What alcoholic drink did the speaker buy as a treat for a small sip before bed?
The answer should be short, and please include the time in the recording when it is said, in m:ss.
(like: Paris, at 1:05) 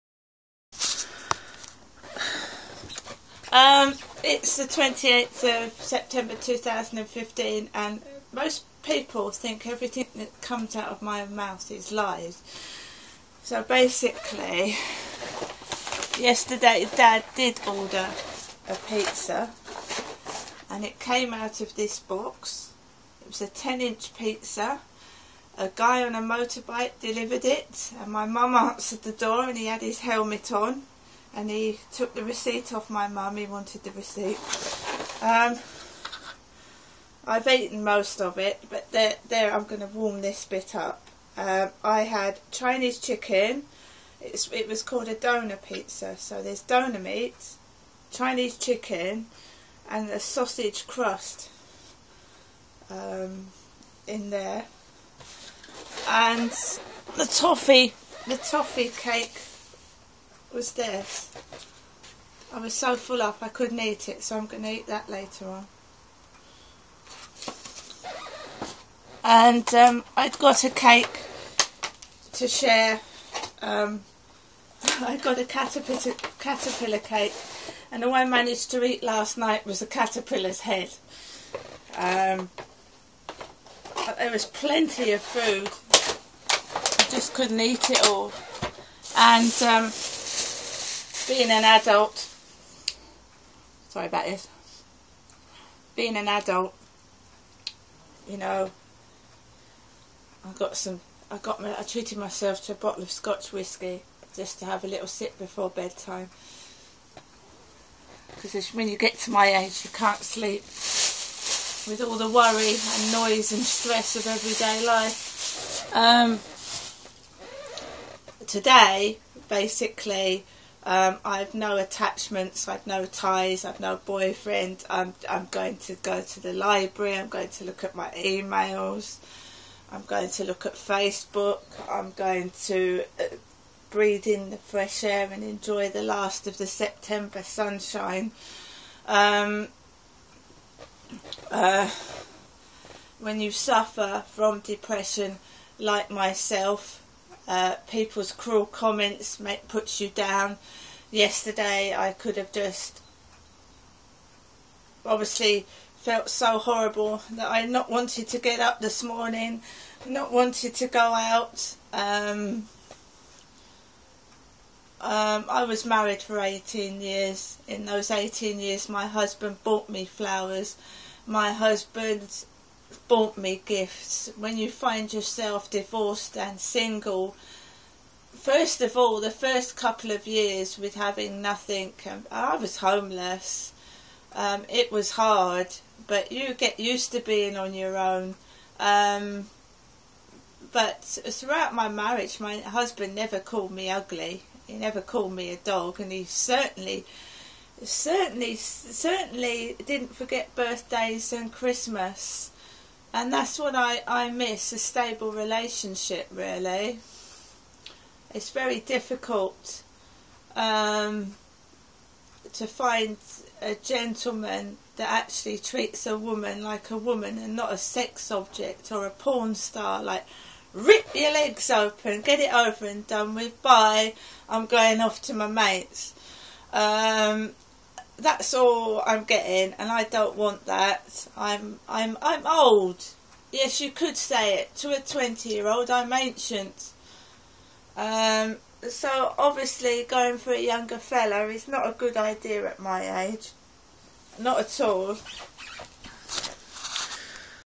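Scotch whiskey, at 1:43.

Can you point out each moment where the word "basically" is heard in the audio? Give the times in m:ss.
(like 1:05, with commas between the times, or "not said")
0:13, 1:59.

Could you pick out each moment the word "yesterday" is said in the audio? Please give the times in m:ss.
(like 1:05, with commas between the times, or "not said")
0:16, 2:31.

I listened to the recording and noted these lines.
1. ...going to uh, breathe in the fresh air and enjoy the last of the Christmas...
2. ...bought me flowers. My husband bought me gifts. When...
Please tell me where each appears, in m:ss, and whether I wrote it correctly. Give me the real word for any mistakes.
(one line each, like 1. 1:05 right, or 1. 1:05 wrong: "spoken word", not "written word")
1. 2:12 wrong: "September", not "Christmas"
2. 2:49 right.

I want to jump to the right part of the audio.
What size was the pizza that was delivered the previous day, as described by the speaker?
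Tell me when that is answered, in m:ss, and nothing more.
0:23.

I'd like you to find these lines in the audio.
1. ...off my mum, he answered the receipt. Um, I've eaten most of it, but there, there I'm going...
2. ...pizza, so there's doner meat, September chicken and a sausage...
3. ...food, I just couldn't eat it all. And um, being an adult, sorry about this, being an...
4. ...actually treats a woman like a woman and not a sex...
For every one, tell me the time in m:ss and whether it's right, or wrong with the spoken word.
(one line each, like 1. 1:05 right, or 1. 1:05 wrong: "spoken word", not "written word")
1. 0:32 wrong: "wanted", not "answered"
2. 0:45 wrong: "Chinese", not "September"
3. 1:25 right
4. 3:35 right.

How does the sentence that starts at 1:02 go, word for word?
I was so full up I couldn't eat it, so I'm going to eat that later on.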